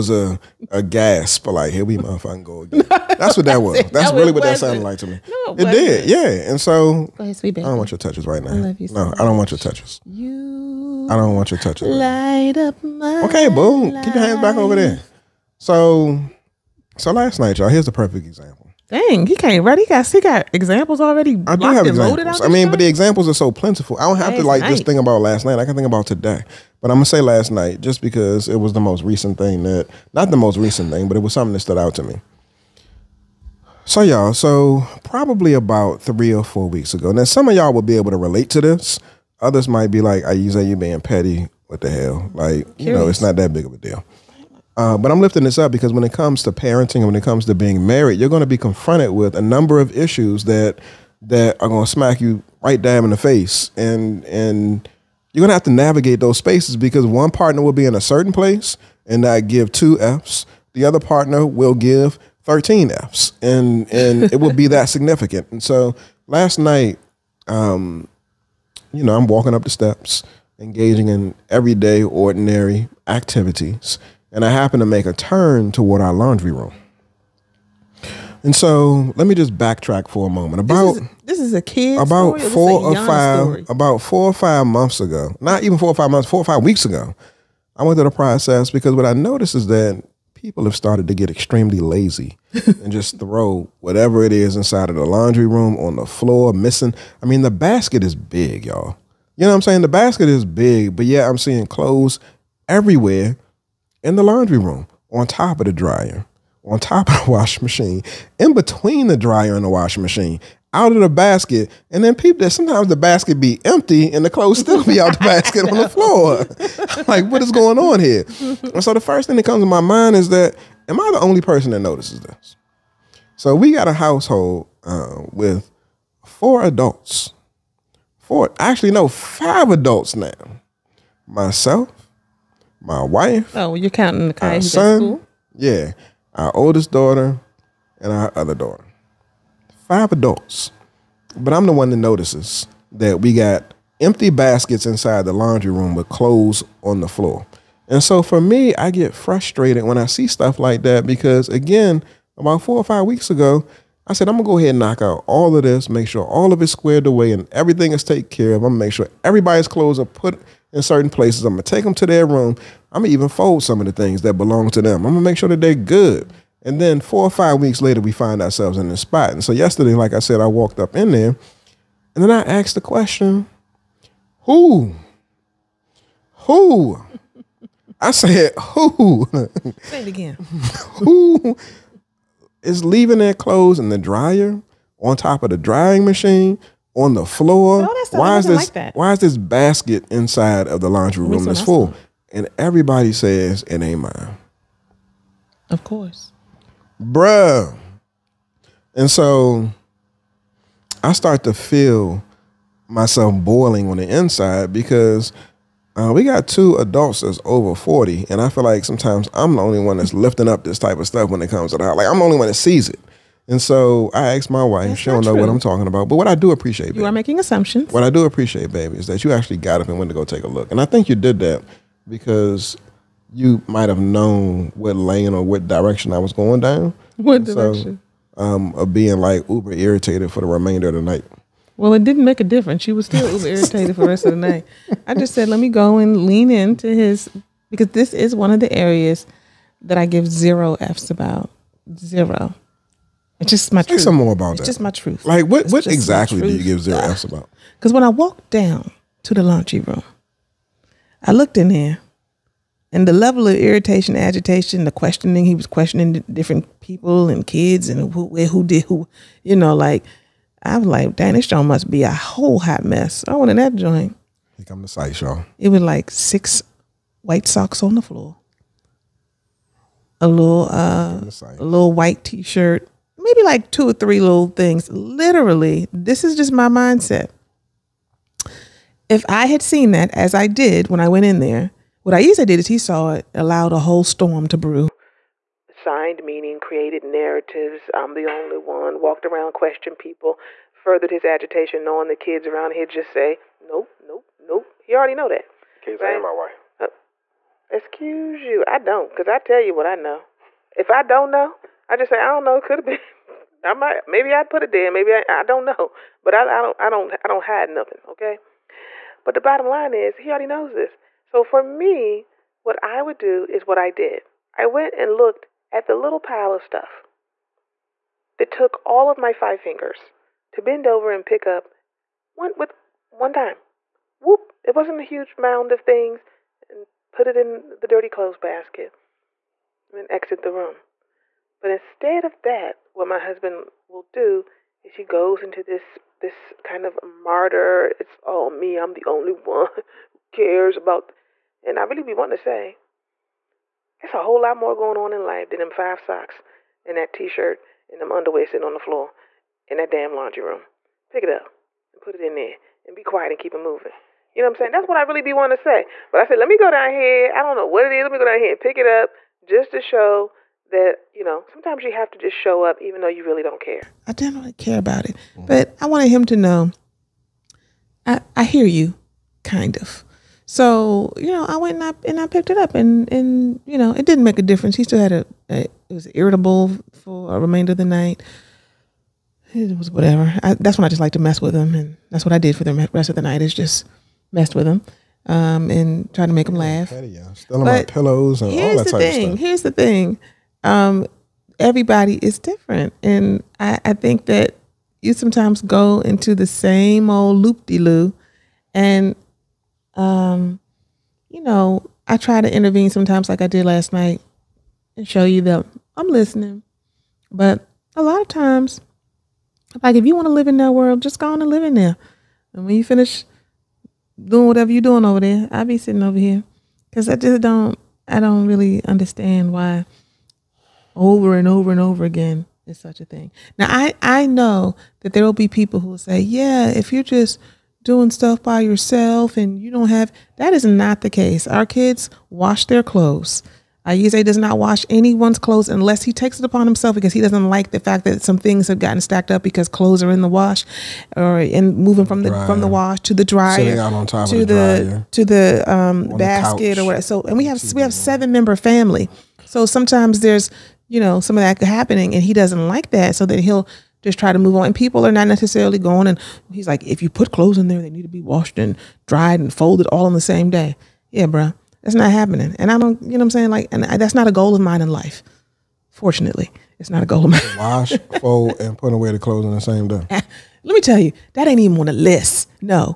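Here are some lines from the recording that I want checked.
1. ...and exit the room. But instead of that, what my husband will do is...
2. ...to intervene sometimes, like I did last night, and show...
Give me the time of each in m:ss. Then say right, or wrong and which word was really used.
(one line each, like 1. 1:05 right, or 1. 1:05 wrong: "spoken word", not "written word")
1. 5:29 right
2. 6:42 right.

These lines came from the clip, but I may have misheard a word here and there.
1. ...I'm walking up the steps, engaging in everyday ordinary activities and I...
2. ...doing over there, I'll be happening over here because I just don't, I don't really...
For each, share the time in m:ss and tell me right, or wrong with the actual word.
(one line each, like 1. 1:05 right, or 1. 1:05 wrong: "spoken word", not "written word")
1. 1:09 right
2. 6:54 wrong: "sitting", not "happening".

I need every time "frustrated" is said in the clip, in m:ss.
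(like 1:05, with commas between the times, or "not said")
2:29.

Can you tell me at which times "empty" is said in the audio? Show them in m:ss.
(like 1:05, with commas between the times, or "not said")
1:53, 2:24.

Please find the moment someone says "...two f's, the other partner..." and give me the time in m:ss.
0:59.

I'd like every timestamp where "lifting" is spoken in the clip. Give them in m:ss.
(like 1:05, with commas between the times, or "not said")
0:45, 3:30.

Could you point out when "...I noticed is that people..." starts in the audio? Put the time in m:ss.
1:29.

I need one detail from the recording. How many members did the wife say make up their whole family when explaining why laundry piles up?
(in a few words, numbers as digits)
7.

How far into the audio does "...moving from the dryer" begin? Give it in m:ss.
7:21.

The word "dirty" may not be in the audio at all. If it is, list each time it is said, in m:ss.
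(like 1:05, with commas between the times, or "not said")
5:27.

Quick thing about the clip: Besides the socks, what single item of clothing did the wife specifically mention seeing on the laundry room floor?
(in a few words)
white t-shirt.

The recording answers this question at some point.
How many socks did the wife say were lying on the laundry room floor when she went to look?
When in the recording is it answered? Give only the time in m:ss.
4:26.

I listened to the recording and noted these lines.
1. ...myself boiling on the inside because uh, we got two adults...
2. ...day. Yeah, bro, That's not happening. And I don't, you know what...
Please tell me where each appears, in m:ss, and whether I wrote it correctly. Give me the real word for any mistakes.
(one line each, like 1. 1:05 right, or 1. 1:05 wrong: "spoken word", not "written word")
1. 3:22 right
2. 7:40 right.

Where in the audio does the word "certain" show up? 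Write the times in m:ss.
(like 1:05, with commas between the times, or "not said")
0:58, 2:40.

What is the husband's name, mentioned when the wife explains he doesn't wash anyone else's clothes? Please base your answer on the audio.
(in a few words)
Ayize.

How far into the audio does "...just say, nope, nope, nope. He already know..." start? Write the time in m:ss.
4:52.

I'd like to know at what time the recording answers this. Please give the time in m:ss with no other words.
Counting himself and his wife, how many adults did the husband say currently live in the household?
2:09.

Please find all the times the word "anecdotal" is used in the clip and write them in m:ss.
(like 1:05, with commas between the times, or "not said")
not said.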